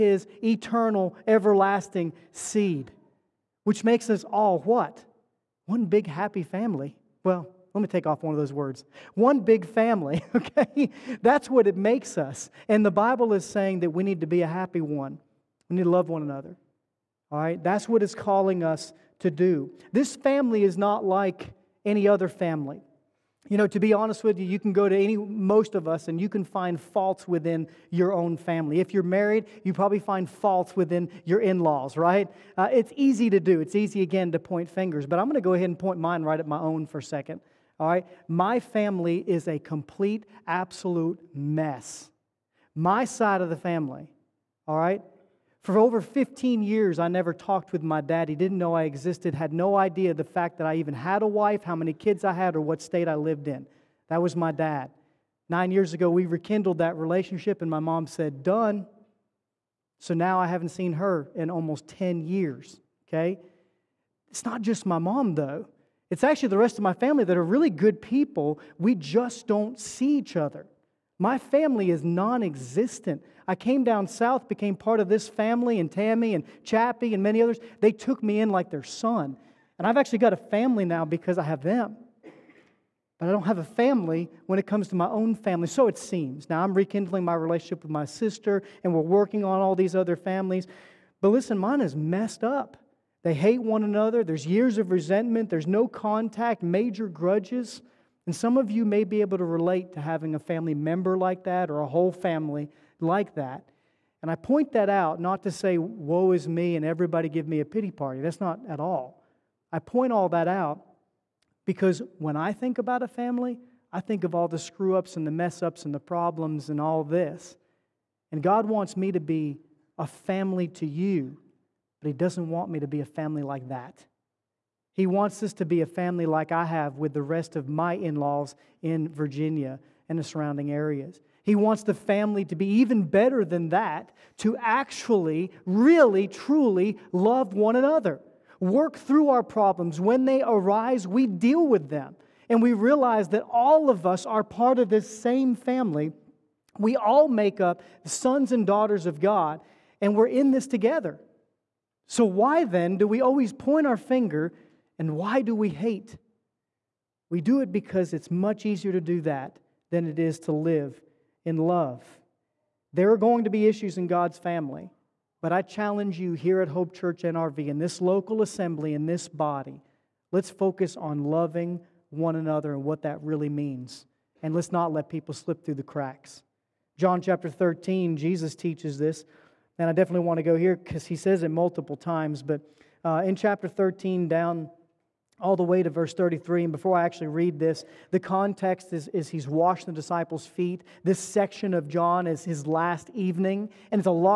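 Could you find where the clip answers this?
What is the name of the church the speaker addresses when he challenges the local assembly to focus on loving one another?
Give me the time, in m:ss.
2:46.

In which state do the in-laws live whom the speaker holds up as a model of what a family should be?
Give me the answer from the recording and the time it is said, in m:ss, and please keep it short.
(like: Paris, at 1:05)
Virginia, at 2:09.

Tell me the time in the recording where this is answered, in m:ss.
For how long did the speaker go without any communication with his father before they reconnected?
0:45.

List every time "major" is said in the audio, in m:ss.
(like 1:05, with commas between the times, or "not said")
1:36.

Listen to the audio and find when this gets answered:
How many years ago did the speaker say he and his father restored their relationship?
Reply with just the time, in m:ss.
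0:55.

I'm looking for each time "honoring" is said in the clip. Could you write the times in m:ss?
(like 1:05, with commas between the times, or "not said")
not said.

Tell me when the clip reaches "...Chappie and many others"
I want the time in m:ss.
1:16.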